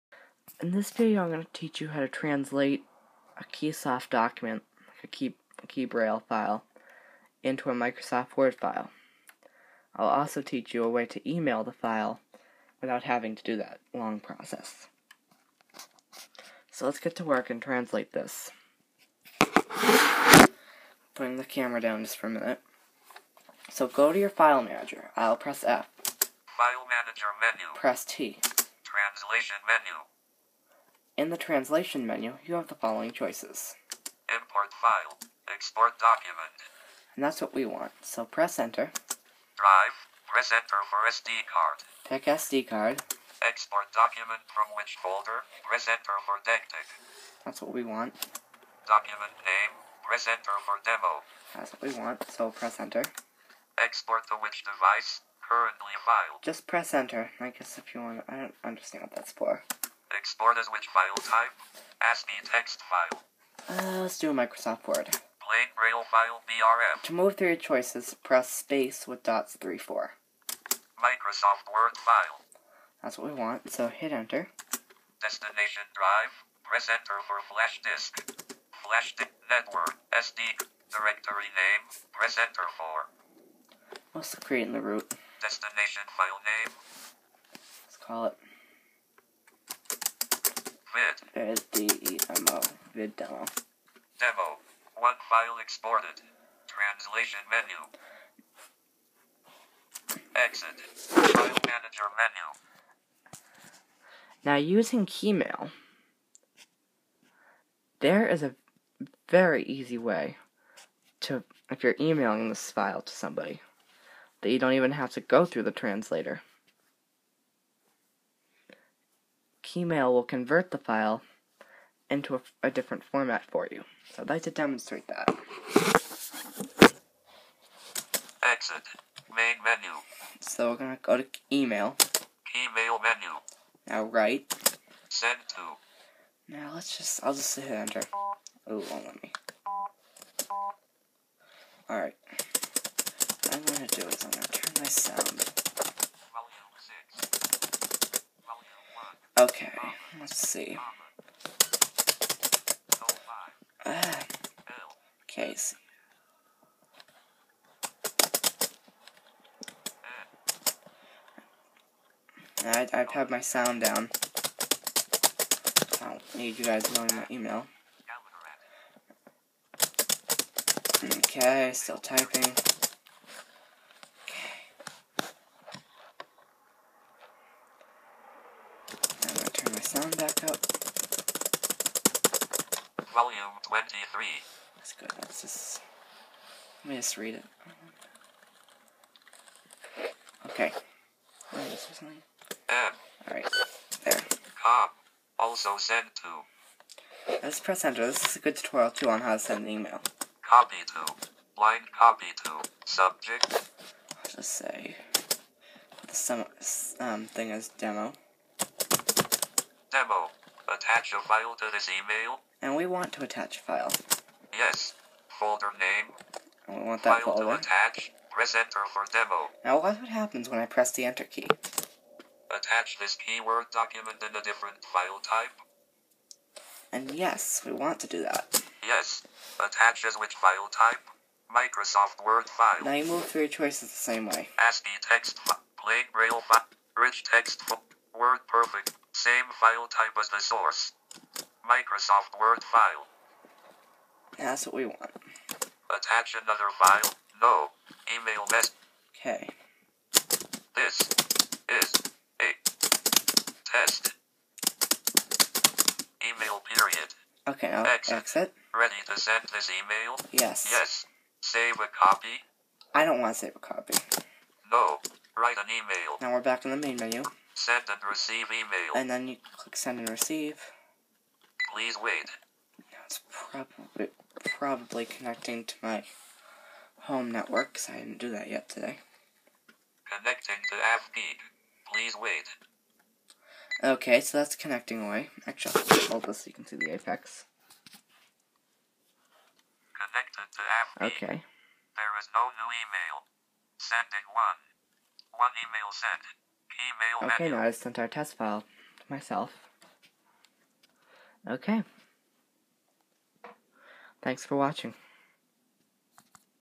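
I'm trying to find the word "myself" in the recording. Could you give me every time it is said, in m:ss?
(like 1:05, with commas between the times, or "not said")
4:59.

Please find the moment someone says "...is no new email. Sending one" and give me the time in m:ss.
4:52.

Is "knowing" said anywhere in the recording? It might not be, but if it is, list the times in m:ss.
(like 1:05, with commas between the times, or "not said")
2:46.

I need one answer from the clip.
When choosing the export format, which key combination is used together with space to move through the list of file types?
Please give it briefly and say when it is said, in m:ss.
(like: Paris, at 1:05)
dots 3, 4, at 1:09.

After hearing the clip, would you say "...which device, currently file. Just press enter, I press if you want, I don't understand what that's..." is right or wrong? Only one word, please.
wrong.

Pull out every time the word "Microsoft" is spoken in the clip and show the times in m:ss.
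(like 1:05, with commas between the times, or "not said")
0:07, 1:04, 1:10, 3:51, 4:01.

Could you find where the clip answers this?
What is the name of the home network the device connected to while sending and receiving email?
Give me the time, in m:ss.
4:40.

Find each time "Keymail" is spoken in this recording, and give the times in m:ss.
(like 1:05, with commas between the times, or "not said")
1:45, 1:59.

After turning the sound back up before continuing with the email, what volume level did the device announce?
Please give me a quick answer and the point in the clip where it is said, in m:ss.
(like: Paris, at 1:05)
23, at 3:03.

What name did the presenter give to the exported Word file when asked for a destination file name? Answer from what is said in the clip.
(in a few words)
Vid demo.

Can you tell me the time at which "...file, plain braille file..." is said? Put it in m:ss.
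3:55.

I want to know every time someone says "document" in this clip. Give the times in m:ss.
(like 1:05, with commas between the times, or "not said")
0:04, 0:35, 0:43, 0:48, 3:43.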